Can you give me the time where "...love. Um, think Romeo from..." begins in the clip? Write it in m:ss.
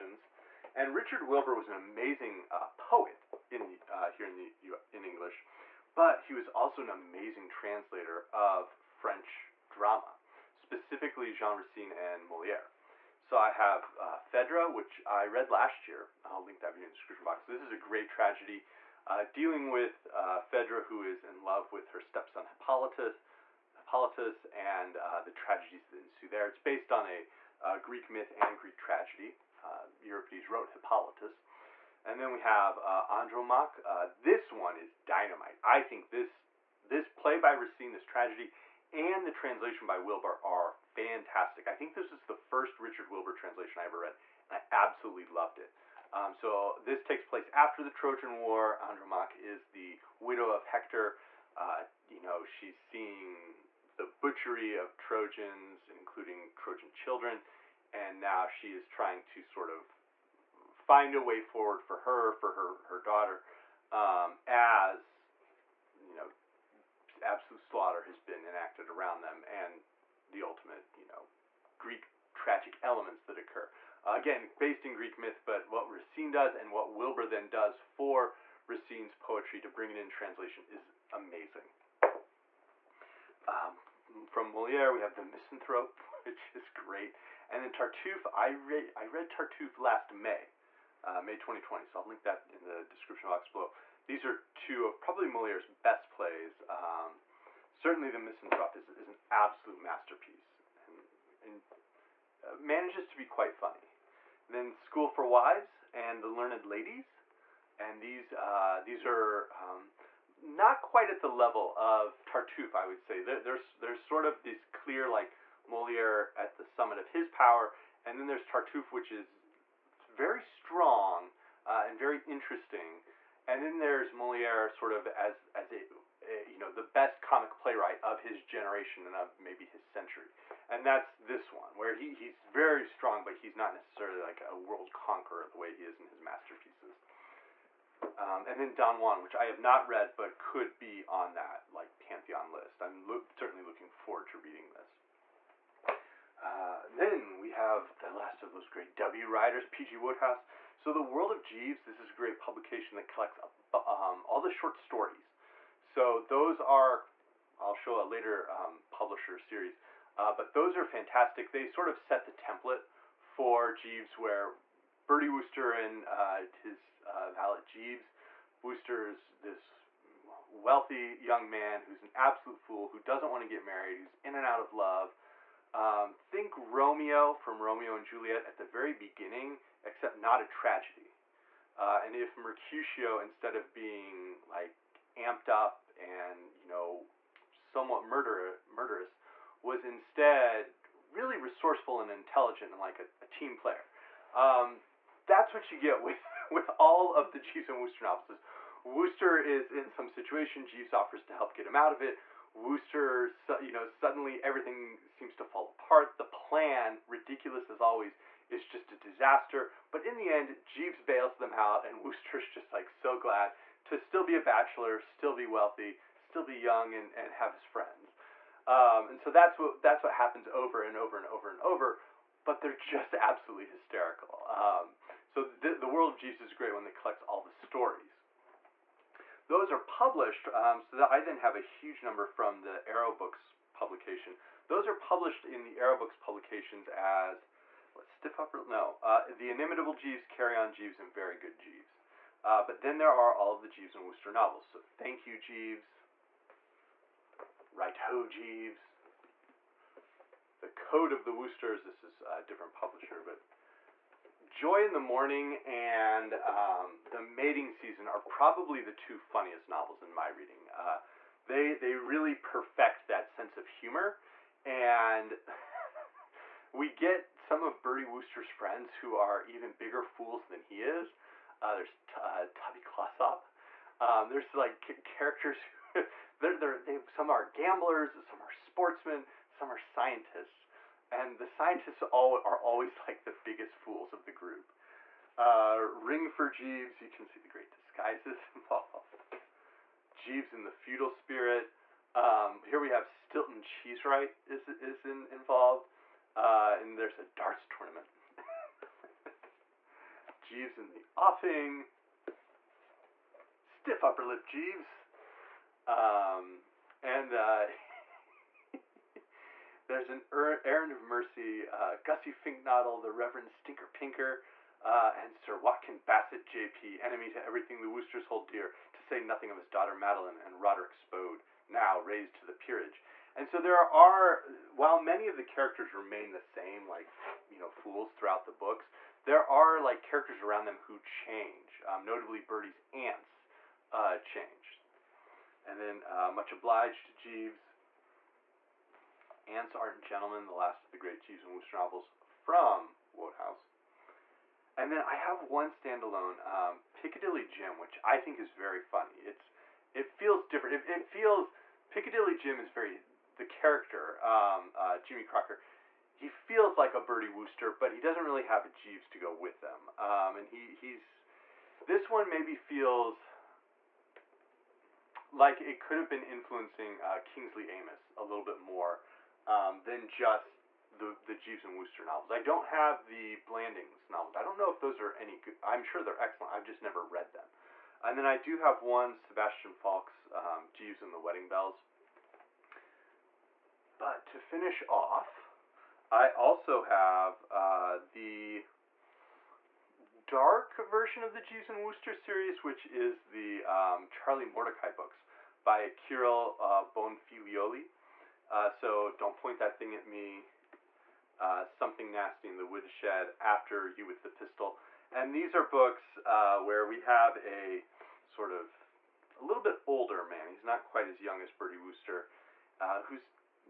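2:54.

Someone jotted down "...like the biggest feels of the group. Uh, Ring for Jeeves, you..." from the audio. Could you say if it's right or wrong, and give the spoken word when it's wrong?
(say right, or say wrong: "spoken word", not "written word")
wrong: "fools", not "feels".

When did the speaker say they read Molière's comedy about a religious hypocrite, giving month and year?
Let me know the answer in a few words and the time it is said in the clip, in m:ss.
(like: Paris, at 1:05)
May 2020, at 1:31.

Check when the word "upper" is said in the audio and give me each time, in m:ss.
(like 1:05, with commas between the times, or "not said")
3:58, 5:04.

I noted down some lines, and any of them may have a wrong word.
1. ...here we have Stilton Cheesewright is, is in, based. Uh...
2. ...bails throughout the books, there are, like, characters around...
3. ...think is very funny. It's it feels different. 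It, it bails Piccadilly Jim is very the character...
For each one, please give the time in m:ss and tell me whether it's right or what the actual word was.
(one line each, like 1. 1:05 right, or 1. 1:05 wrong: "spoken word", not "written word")
1. 4:52 wrong: "involved", not "based"
2. 5:27 wrong: "fools", not "bails"
3. 5:48 wrong: "feels", not "bails".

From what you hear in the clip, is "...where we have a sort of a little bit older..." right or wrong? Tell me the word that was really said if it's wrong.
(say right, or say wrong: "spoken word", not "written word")
right.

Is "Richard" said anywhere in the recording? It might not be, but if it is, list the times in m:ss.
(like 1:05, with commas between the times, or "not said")
0:00, 0:42.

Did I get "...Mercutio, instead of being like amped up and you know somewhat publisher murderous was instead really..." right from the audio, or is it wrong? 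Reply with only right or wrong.
wrong.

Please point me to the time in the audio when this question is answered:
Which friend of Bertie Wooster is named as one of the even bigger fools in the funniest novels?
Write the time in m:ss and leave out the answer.
4:32.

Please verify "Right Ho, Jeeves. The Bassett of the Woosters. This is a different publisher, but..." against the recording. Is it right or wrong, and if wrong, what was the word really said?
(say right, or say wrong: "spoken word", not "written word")
wrong: "Code", not "Bassett".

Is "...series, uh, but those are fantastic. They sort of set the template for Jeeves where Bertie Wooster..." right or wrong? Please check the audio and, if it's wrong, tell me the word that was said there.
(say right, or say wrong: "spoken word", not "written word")
right.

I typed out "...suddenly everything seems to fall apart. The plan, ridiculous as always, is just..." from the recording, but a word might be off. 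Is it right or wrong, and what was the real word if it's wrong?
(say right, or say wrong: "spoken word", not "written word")
right.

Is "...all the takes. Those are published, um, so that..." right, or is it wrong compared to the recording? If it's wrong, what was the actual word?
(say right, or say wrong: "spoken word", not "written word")
wrong: "stories", not "takes".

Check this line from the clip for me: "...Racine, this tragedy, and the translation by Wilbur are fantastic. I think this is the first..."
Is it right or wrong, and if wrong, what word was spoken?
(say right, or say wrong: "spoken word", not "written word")
right.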